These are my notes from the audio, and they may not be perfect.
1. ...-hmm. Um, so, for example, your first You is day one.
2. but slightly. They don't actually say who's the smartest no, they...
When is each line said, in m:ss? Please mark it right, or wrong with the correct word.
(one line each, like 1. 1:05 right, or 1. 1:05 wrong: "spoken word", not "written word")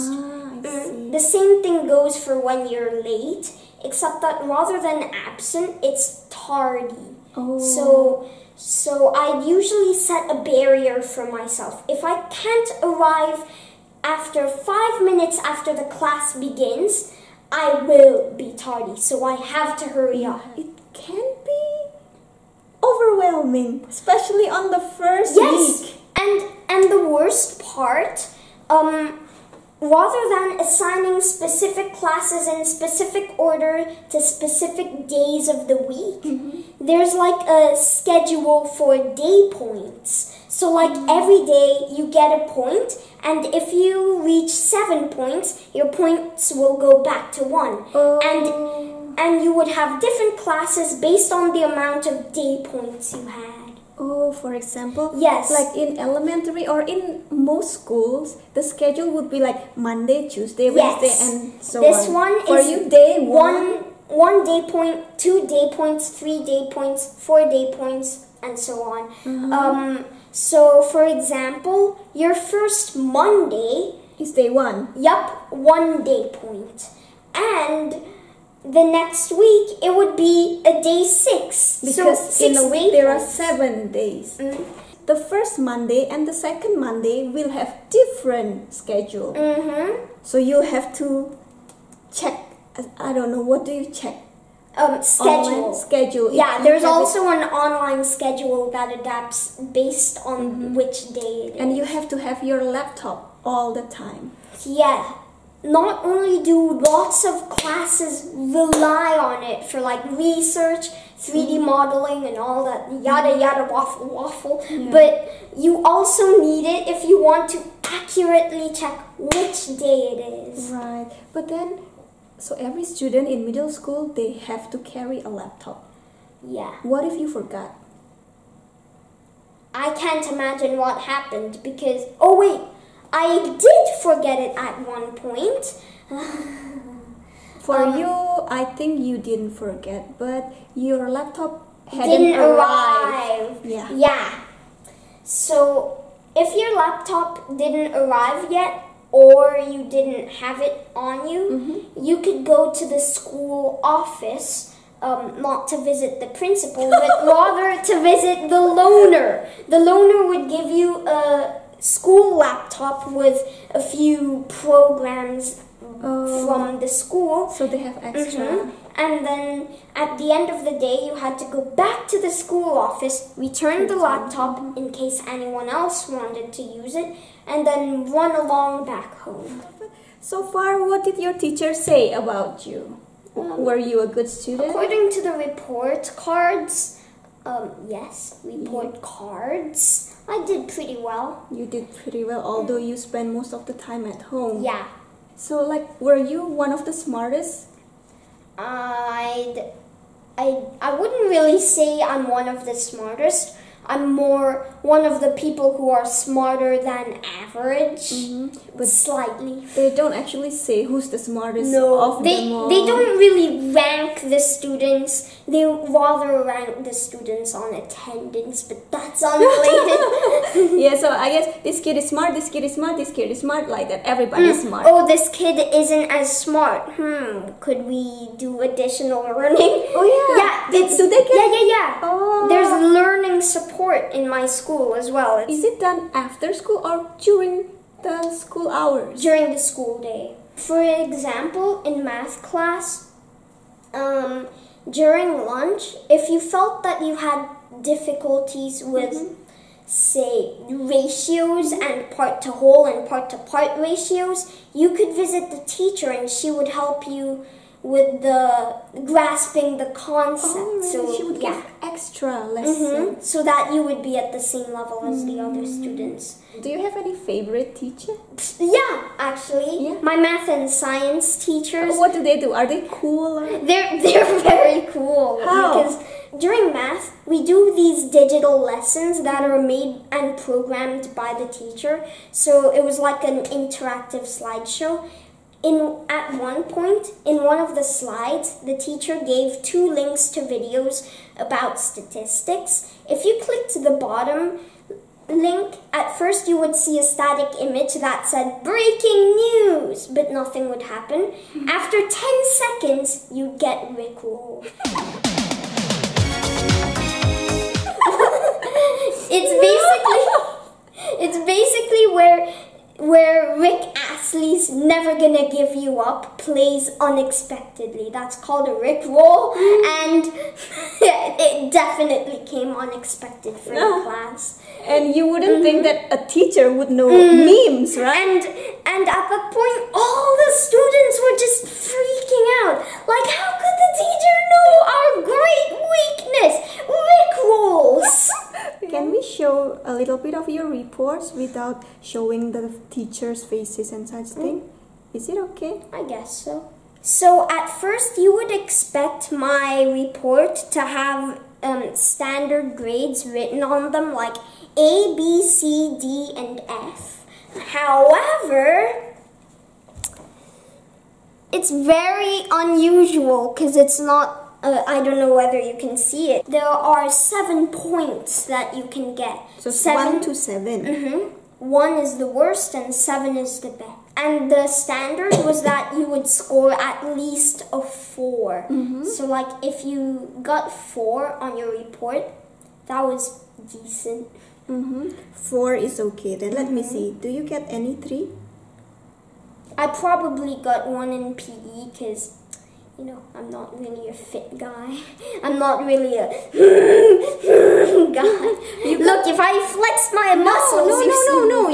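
1. 1:09 wrong: "Monday", not "You"
2. 3:28 right.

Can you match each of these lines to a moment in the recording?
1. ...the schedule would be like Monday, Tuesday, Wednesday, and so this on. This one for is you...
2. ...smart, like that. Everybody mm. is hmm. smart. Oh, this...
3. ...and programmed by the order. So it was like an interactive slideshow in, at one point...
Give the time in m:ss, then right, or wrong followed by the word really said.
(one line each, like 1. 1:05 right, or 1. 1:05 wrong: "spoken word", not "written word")
1. 0:58 right
2. 3:43 right
3. 4:40 wrong: "teacher", not "order".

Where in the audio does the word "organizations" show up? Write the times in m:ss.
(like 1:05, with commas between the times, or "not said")
not said.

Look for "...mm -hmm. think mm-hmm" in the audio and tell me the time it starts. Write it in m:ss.
5:25.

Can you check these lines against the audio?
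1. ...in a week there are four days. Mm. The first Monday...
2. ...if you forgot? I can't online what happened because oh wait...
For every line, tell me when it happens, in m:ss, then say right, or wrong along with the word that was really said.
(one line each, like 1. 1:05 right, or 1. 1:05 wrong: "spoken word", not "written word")
1. 1:22 wrong: "seven", not "four"
2. 2:07 wrong: "imagine", not "online".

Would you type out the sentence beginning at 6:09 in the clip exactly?
So seven, one to 7 Mm-hmm.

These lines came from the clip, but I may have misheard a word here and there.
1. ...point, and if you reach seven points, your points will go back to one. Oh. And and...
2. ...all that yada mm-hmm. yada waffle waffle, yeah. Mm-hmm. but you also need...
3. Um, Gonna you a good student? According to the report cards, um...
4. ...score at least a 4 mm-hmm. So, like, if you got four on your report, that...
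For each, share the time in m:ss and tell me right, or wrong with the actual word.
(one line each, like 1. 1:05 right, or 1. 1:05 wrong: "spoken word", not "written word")
1. 0:42 right
2. 1:52 right
3. 3:03 wrong: "Were", not "Gonna"
4. 6:16 right.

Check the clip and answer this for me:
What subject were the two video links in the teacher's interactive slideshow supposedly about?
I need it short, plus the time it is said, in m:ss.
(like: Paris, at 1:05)
Statistics, at 4:51.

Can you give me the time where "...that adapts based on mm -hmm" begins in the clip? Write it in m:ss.
1:38.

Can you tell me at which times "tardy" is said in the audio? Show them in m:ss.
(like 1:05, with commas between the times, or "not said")
0:06, 0:18.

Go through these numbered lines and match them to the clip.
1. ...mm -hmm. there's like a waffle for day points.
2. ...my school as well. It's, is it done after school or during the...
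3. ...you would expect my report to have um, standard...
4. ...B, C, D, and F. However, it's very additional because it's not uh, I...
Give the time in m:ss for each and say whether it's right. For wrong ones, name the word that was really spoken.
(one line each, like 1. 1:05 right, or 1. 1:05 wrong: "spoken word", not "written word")
1. 0:36 wrong: "schedule", not "waffle"
2. 3:54 right
3. 5:48 right
4. 5:55 wrong: "unusual", not "additional".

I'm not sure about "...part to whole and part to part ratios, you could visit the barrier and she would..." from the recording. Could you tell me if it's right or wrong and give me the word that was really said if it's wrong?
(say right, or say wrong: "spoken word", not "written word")
wrong: "teacher", not "barrier".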